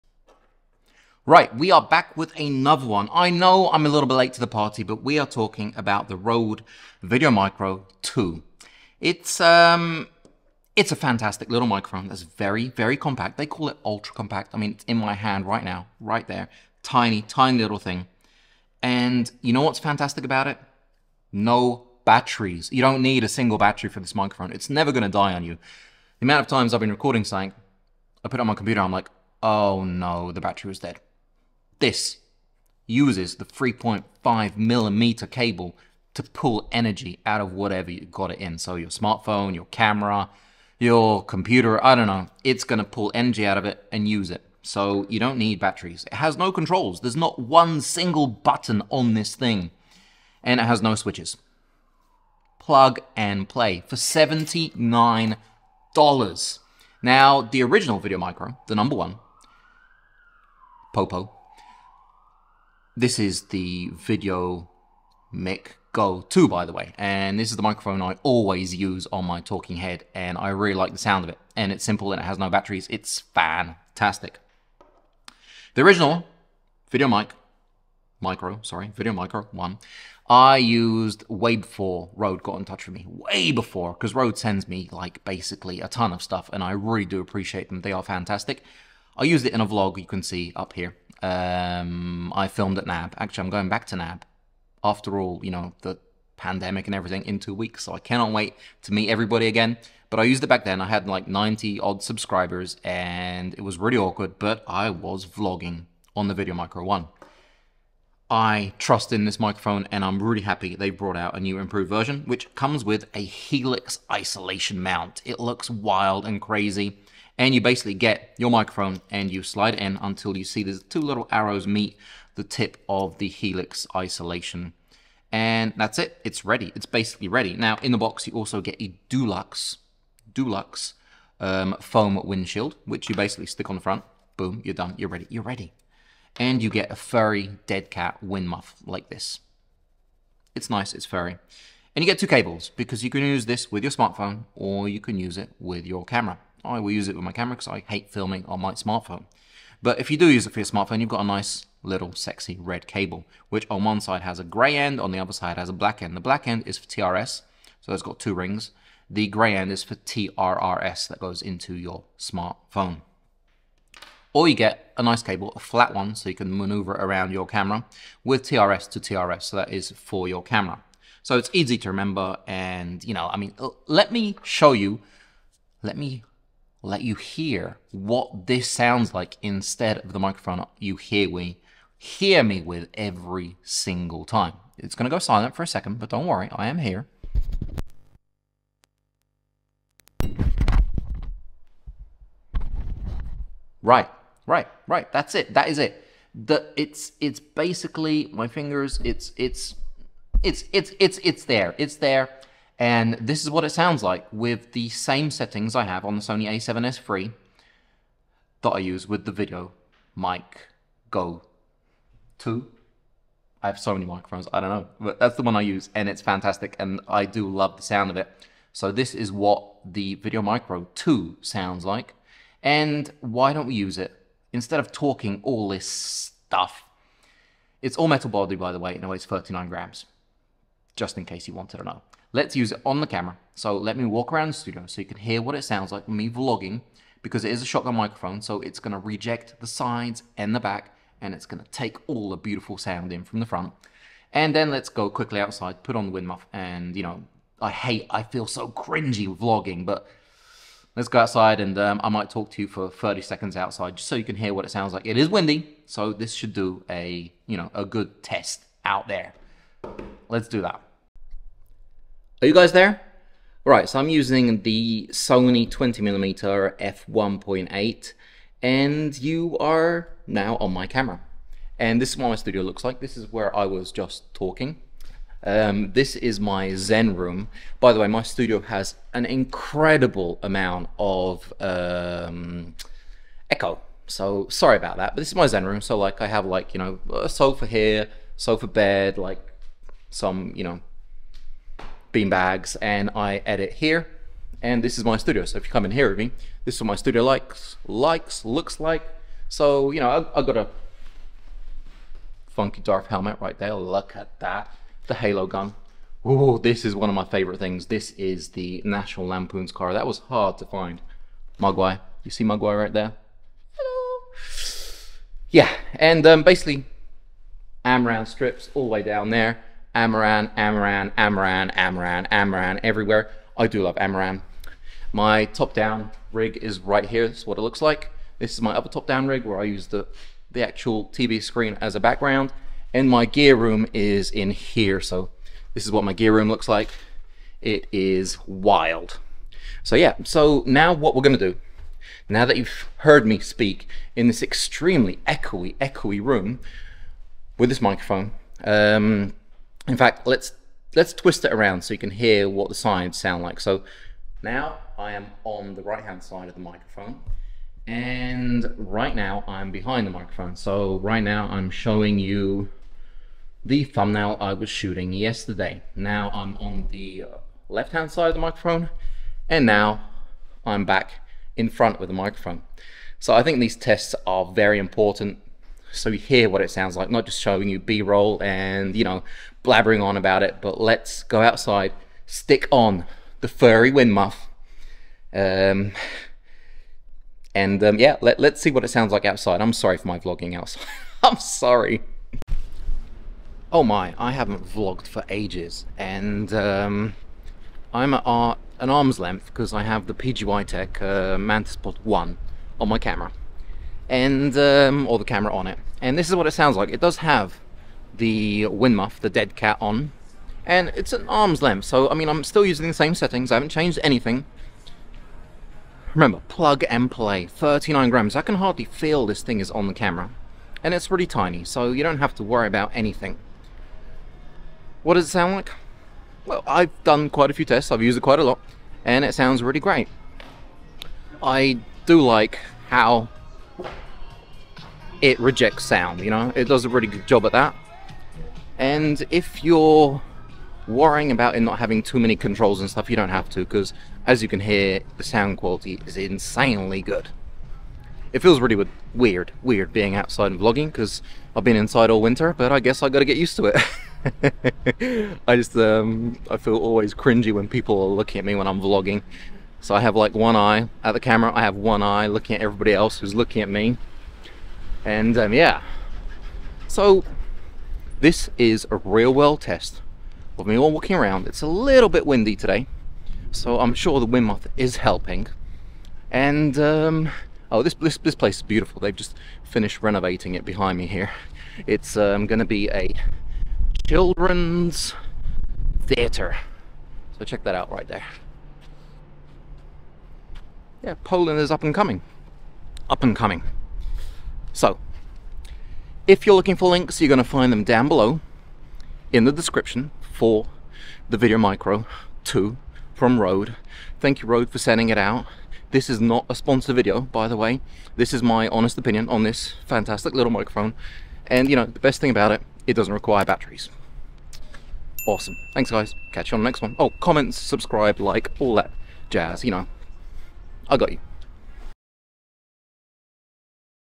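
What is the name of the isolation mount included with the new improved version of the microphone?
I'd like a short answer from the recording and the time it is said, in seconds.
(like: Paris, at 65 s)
Helix isolation mount, at 113 s.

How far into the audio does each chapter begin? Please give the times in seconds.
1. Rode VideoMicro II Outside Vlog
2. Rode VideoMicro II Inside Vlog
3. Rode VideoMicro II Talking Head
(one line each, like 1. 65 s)
1. 392 s
2. 261 s
3. 192 s.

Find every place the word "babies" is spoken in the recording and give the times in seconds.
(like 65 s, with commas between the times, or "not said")
not said.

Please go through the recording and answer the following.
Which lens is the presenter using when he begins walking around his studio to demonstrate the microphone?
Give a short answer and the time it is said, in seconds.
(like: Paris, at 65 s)
Sony 20mm f1.8, at 265 s.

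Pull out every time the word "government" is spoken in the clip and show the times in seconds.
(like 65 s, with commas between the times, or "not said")
not said.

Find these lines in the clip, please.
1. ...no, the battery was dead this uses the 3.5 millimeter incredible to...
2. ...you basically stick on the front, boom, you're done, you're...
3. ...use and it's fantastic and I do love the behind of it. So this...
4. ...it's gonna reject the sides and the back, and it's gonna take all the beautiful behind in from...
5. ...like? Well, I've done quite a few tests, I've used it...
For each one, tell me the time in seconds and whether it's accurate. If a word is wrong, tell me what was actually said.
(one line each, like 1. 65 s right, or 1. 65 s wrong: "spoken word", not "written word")
1. 29 s wrong: "cable", not "incredible"
2. 133 s right
3. 215 s wrong: "sound", not "behind"
4. 238 s wrong: "sound", not "behind"
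5. 425 s right.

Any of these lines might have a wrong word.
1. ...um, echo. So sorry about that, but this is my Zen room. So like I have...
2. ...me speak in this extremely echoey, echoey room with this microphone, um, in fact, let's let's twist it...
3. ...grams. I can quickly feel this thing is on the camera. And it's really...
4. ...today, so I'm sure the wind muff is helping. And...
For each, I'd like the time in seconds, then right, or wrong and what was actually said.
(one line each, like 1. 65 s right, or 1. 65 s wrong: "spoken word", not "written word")
1. 281 s right
2. 343 s right
3. 418 s wrong: "hardly", not "quickly"
4. 472 s right.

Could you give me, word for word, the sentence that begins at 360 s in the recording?
So right now I'm showing you the thumbnail I was shooting yesterday.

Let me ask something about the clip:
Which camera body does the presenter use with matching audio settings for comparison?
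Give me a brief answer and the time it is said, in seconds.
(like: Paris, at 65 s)
Sony a7S III, at 206 s.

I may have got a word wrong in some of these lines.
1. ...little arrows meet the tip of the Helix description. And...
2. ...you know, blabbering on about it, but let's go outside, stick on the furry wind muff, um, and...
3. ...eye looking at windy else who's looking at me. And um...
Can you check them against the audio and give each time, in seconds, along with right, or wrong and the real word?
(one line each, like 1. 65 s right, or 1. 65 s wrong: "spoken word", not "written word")
1. 121 s wrong: "isolation", not "description"
2. 378 s right
3. 462 s wrong: "everybody", not "windy".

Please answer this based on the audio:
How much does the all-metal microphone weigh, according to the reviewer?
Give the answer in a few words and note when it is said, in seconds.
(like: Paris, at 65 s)
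39 grams, at 229 s.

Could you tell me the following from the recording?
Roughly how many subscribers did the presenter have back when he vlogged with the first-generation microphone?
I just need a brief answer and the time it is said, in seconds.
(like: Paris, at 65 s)
90, at 101 s.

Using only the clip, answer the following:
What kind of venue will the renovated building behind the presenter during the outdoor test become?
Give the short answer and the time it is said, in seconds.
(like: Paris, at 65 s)
children's theater, at 484 s.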